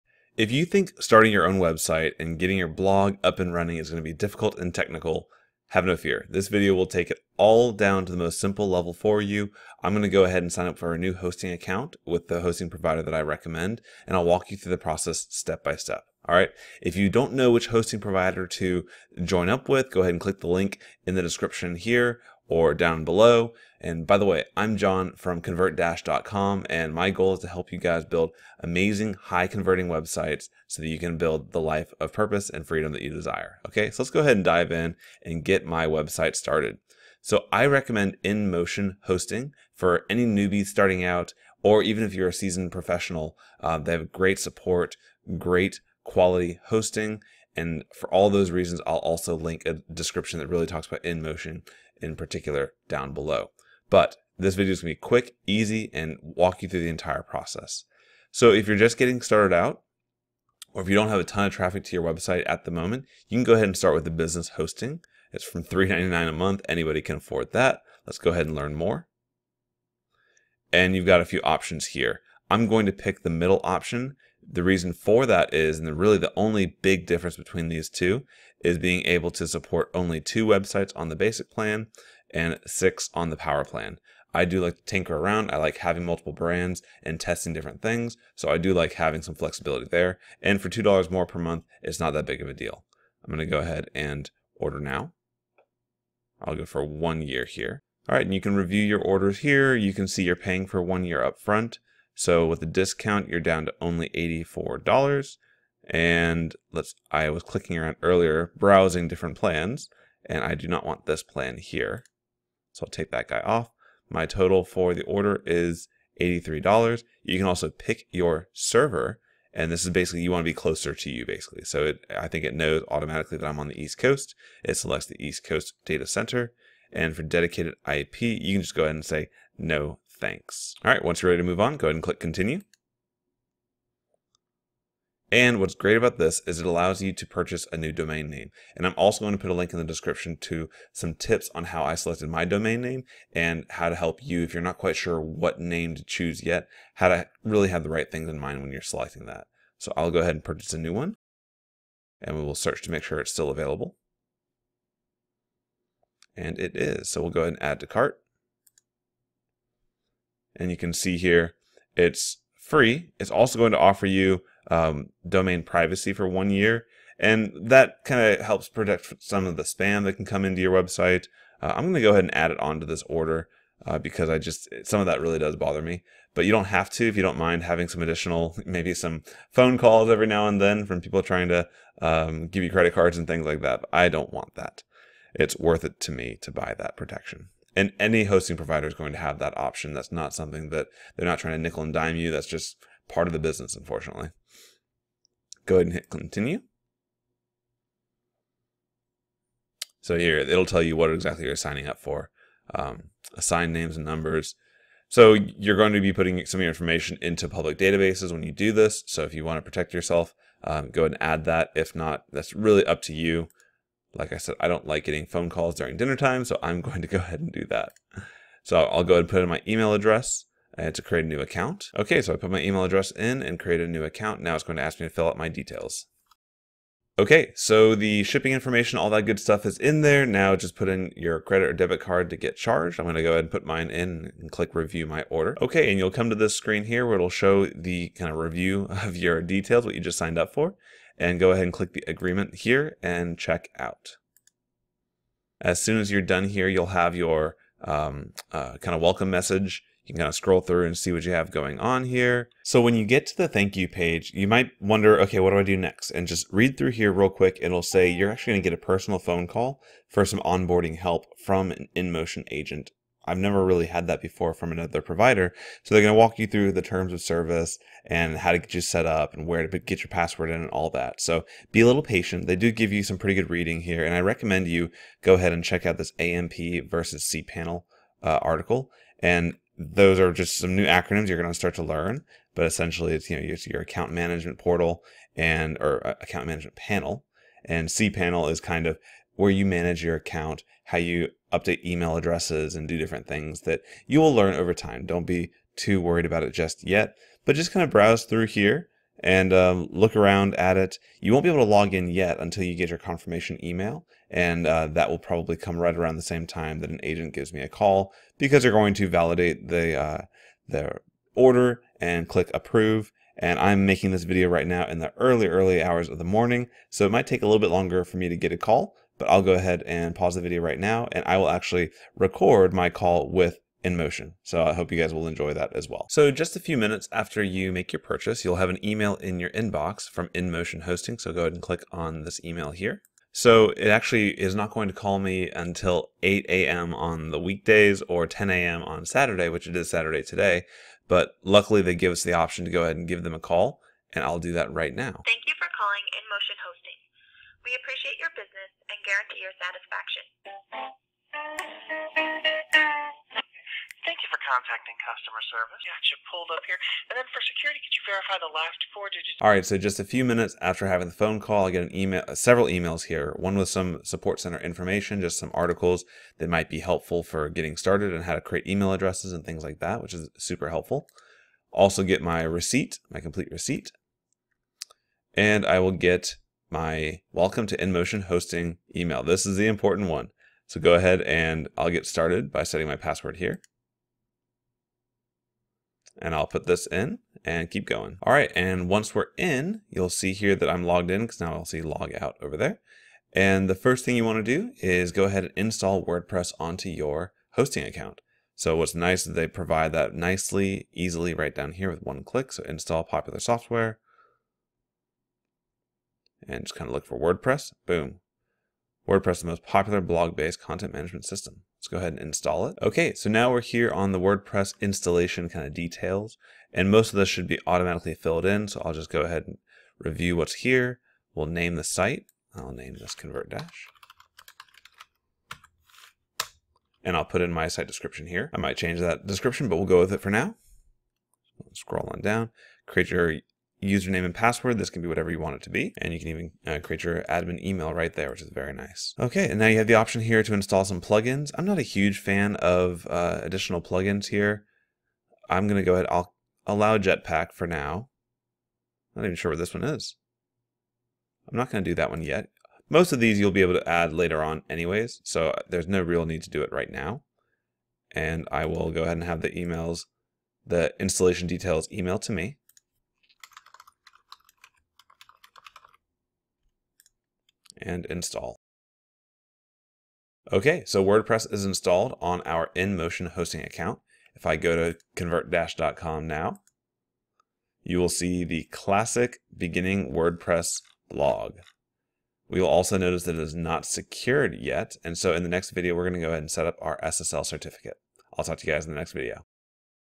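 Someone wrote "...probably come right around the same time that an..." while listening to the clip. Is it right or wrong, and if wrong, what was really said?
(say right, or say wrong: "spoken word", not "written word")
right.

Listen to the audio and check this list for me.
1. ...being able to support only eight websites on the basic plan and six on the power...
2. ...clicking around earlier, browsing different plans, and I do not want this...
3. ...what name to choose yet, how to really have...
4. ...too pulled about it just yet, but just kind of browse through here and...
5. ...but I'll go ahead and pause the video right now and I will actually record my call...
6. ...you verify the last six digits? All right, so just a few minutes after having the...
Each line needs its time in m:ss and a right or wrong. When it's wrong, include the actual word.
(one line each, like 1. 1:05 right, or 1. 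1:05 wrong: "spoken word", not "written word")
1. 1:18 wrong: "two", not "eight"
2. 1:47 right
3. 2:25 right
4. 4:55 wrong: "worried", not "pulled"
5. 5:19 right
6. 5:57 wrong: "four", not "six".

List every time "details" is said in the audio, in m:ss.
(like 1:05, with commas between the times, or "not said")
3:45, 3:59, 6:55, 7:41.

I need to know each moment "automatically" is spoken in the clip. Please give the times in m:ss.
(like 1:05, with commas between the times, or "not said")
2:02, 6:57.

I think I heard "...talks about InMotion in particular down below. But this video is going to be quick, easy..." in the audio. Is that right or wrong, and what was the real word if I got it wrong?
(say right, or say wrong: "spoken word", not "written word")
right.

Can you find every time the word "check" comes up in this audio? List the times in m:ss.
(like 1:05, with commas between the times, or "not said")
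4:03, 4:35.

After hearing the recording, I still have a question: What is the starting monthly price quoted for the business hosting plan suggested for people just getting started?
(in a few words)
$3.99.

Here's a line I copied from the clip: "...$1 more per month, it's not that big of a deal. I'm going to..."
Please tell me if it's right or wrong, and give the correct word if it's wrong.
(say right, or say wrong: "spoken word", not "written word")
wrong: "2", not "1".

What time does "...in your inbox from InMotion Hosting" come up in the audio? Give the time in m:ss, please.
5:29.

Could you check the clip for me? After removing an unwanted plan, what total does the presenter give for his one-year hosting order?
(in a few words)
$83.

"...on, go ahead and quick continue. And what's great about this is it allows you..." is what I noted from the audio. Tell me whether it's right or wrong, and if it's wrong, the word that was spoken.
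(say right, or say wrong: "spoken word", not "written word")
wrong: "click", not "quick".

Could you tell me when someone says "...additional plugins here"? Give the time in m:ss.
7:23.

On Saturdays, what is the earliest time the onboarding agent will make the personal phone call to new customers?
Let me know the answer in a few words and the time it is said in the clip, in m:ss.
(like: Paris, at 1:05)
10 a.m., at 5:38.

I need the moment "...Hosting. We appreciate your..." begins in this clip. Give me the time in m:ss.
5:46.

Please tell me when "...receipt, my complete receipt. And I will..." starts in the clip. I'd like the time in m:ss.
6:12.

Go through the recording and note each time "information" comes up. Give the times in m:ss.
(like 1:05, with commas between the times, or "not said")
3:26, 3:48, 6:04.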